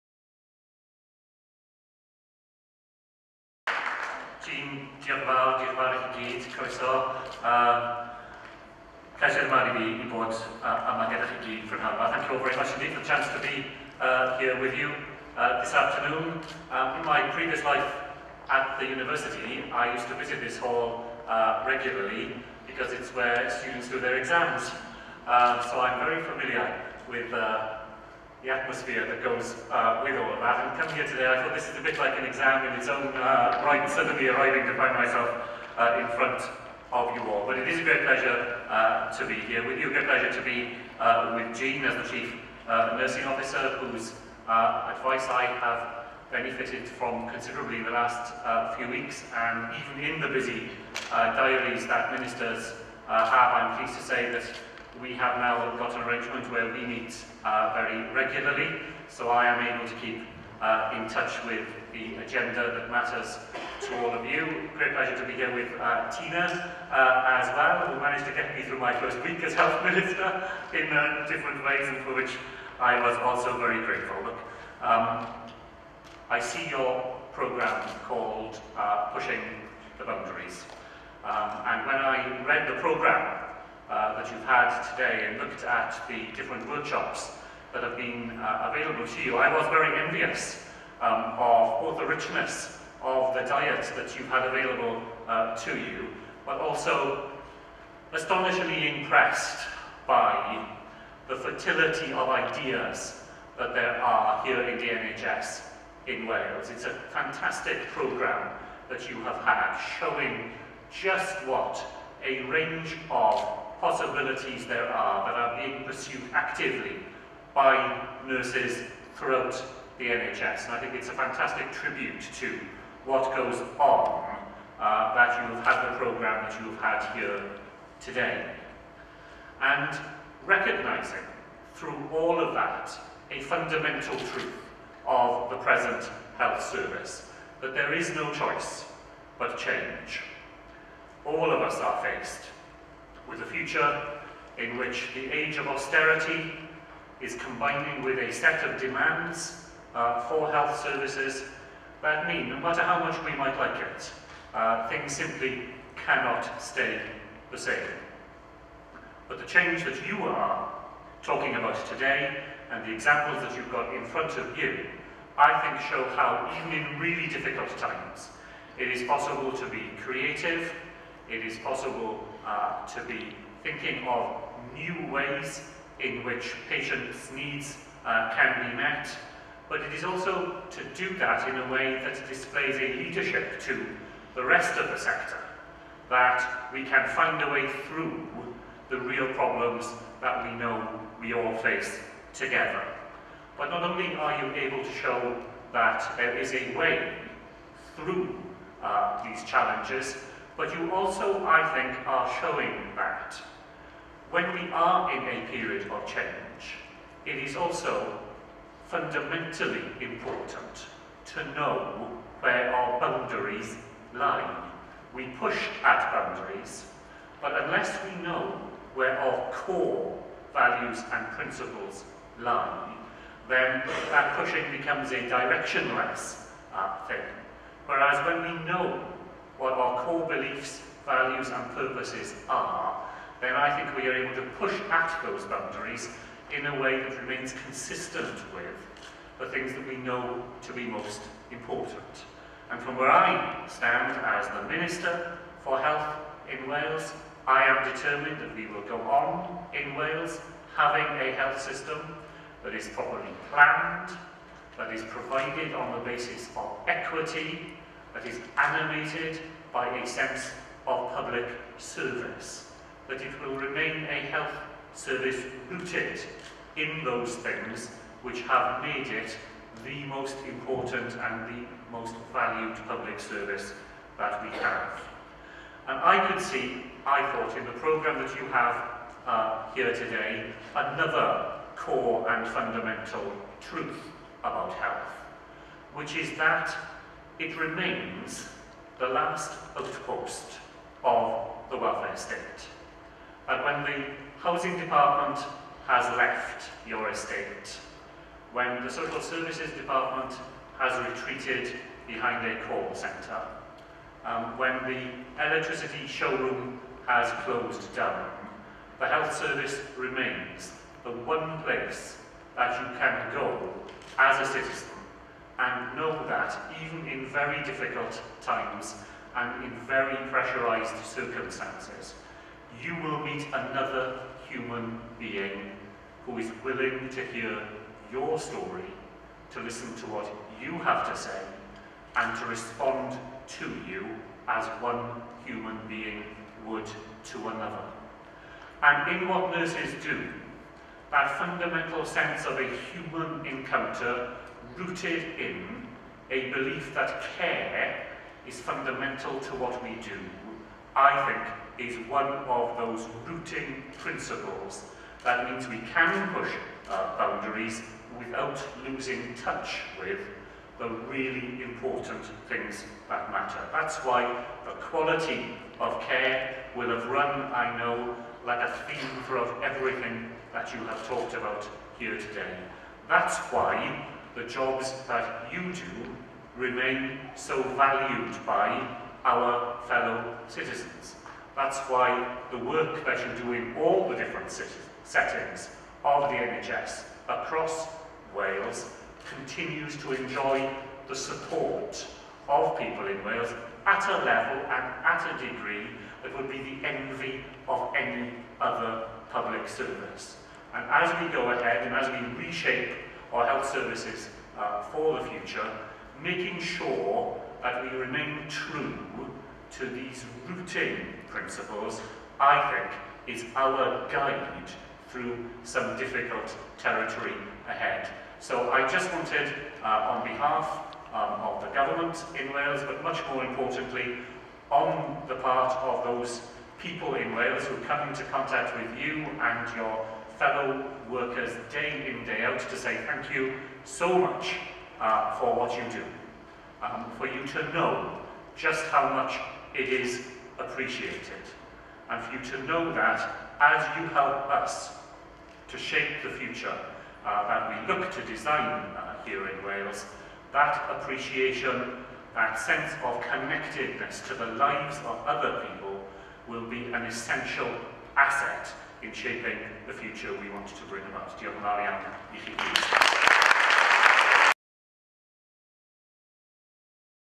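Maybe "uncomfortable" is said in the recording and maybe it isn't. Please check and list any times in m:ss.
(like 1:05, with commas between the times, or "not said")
not said.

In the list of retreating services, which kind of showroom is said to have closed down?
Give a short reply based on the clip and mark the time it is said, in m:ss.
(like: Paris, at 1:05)
electricity showroom, at 5:05.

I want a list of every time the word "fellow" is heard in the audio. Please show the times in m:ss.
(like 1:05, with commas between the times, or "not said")
6:19, 7:10.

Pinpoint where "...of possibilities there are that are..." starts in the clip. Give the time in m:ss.
1:52.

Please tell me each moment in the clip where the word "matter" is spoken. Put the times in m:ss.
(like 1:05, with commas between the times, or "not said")
1:02, 2:32, 6:03.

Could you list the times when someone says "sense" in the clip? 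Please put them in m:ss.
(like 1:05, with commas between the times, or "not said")
4:20, 5:42, 7:32.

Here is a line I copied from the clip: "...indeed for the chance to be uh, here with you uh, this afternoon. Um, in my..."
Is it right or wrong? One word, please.
right.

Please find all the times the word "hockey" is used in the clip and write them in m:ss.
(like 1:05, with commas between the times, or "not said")
not said.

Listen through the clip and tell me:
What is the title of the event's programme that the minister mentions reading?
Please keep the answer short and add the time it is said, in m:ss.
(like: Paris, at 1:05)
Pushing the Boundaries, at 1:19.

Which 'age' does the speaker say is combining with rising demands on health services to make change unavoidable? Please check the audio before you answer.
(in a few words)
age of austerity.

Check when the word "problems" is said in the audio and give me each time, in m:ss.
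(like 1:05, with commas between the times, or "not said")
3:09.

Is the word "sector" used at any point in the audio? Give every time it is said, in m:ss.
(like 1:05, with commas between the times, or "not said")
3:04.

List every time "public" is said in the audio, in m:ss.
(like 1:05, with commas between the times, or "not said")
4:21, 4:32, 6:39.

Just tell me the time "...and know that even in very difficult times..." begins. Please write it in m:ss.
5:15.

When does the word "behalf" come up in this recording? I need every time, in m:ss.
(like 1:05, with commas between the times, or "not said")
7:00.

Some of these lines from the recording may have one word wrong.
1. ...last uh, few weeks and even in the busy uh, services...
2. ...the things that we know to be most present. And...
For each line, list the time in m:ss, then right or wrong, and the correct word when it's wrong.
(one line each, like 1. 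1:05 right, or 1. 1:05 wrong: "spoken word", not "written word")
1. 0:47 wrong: "diaries", not "services"
2. 3:59 wrong: "important", not "present".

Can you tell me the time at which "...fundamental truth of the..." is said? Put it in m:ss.
2:13.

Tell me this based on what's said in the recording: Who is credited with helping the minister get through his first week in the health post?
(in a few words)
Tina.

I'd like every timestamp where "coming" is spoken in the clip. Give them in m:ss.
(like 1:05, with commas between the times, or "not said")
0:30.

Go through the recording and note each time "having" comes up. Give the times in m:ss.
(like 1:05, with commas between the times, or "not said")
4:10.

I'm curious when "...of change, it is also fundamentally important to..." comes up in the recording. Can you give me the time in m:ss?
3:25.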